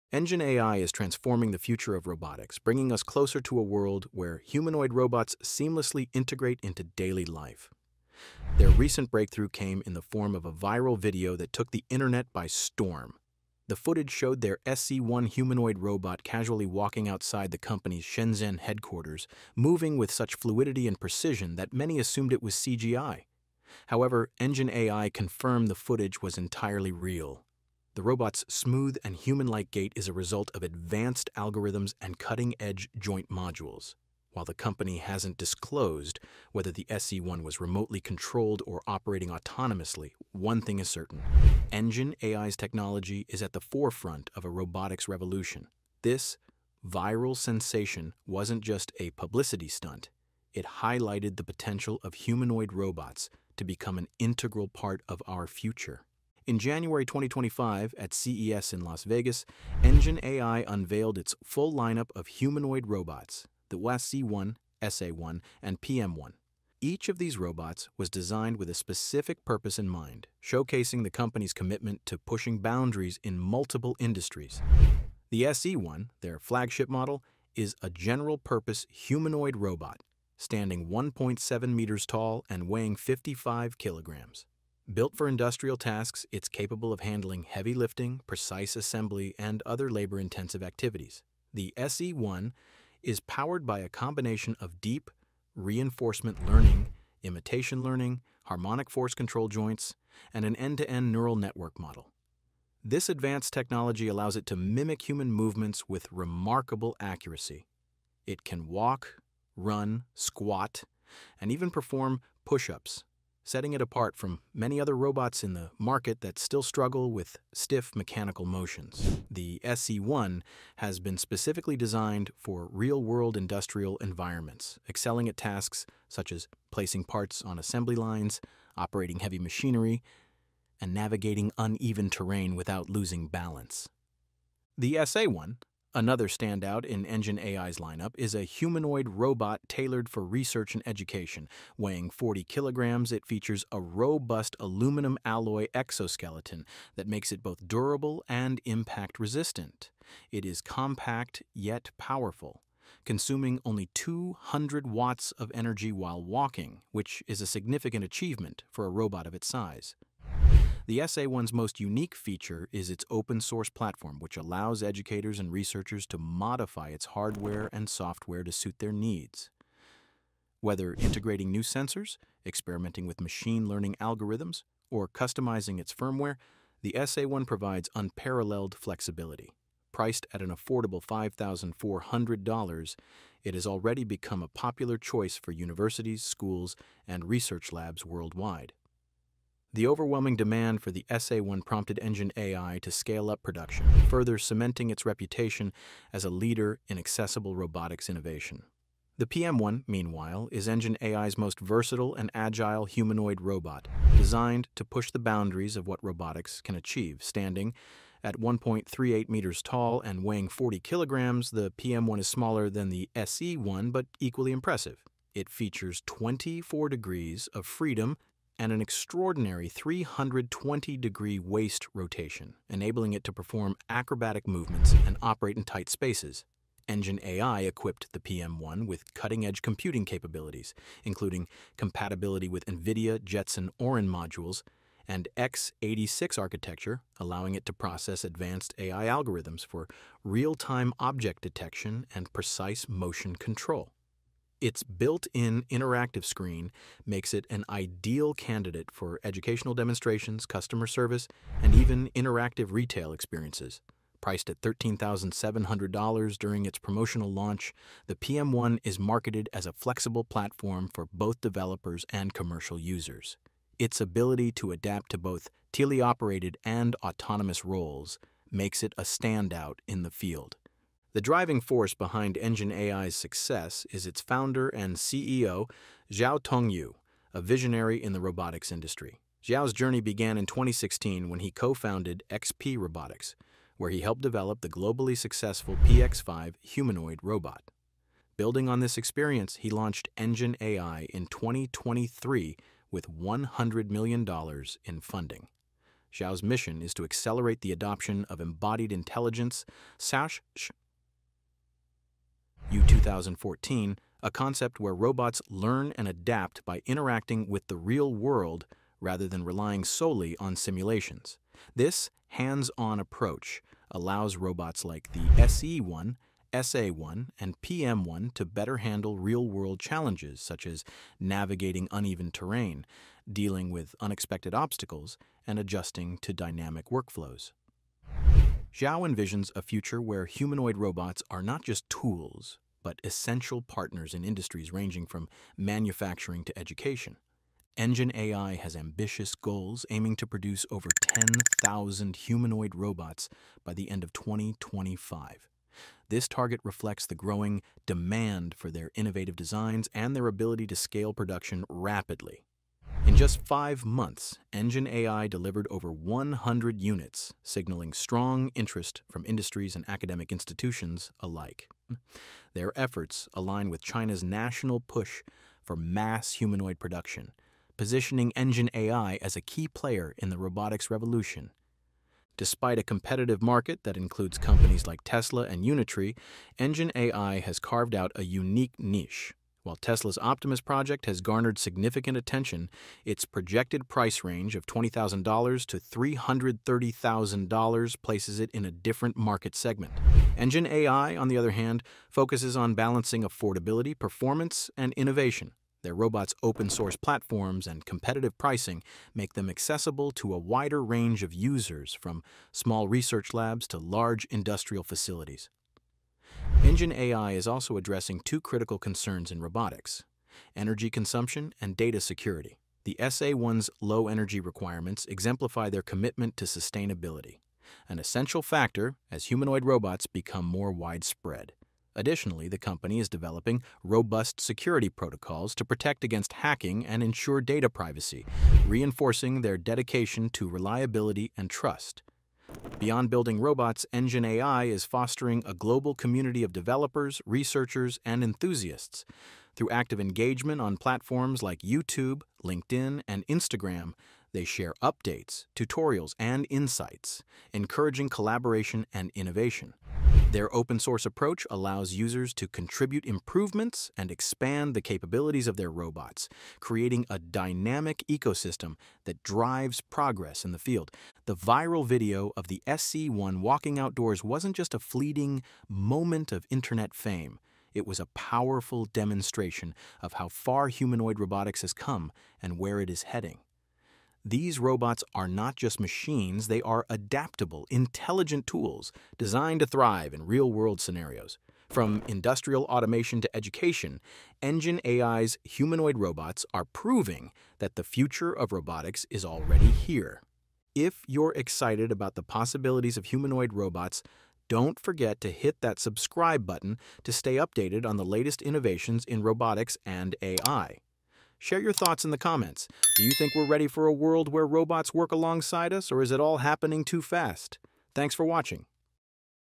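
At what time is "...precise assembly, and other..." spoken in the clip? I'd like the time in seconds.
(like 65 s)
88 s.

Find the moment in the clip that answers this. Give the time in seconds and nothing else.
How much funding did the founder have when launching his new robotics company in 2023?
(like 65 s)
293 s.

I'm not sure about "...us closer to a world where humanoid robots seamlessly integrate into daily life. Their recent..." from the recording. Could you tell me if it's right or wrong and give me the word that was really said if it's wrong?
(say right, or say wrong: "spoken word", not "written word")
right.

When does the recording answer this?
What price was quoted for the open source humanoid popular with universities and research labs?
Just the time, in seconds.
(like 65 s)
181 s.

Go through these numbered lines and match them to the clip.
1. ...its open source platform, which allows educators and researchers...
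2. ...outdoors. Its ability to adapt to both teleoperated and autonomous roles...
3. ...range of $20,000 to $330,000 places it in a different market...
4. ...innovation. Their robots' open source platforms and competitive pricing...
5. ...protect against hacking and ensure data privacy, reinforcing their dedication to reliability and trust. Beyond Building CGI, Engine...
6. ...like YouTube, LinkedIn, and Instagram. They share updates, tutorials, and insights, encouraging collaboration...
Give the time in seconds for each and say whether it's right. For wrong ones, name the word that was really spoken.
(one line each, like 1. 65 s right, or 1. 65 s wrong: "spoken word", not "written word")
1. 162 s right
2. 262 s wrong: "users", not "outdoors"
3. 384 s right
4. 394 s right
5. 425 s wrong: "Robots", not "CGI"
6. 441 s right.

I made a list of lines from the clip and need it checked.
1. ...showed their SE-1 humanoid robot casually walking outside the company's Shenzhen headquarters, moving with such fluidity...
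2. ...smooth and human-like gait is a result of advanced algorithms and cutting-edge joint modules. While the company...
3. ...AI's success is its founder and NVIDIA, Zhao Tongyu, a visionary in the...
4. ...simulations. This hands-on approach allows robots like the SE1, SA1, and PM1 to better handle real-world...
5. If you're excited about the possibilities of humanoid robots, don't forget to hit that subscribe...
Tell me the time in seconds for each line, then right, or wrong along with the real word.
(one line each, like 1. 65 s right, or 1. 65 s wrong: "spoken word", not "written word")
1. 14 s right
2. 28 s right
3. 272 s wrong: "CEO", not "NVIDIA"
4. 310 s right
5. 490 s right.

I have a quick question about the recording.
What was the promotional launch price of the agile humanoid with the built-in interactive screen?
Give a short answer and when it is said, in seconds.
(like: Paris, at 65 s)
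$13,700, at 254 s.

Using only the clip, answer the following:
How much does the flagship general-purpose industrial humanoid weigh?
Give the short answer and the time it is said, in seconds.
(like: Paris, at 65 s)
55 kilograms, at 82 s.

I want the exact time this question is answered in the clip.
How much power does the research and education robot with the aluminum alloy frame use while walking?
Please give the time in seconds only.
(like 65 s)
153 s.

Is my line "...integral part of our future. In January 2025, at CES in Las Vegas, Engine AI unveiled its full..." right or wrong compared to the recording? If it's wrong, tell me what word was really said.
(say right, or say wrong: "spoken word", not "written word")
right.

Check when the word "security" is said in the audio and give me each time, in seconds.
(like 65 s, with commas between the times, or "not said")
411 s, 424 s.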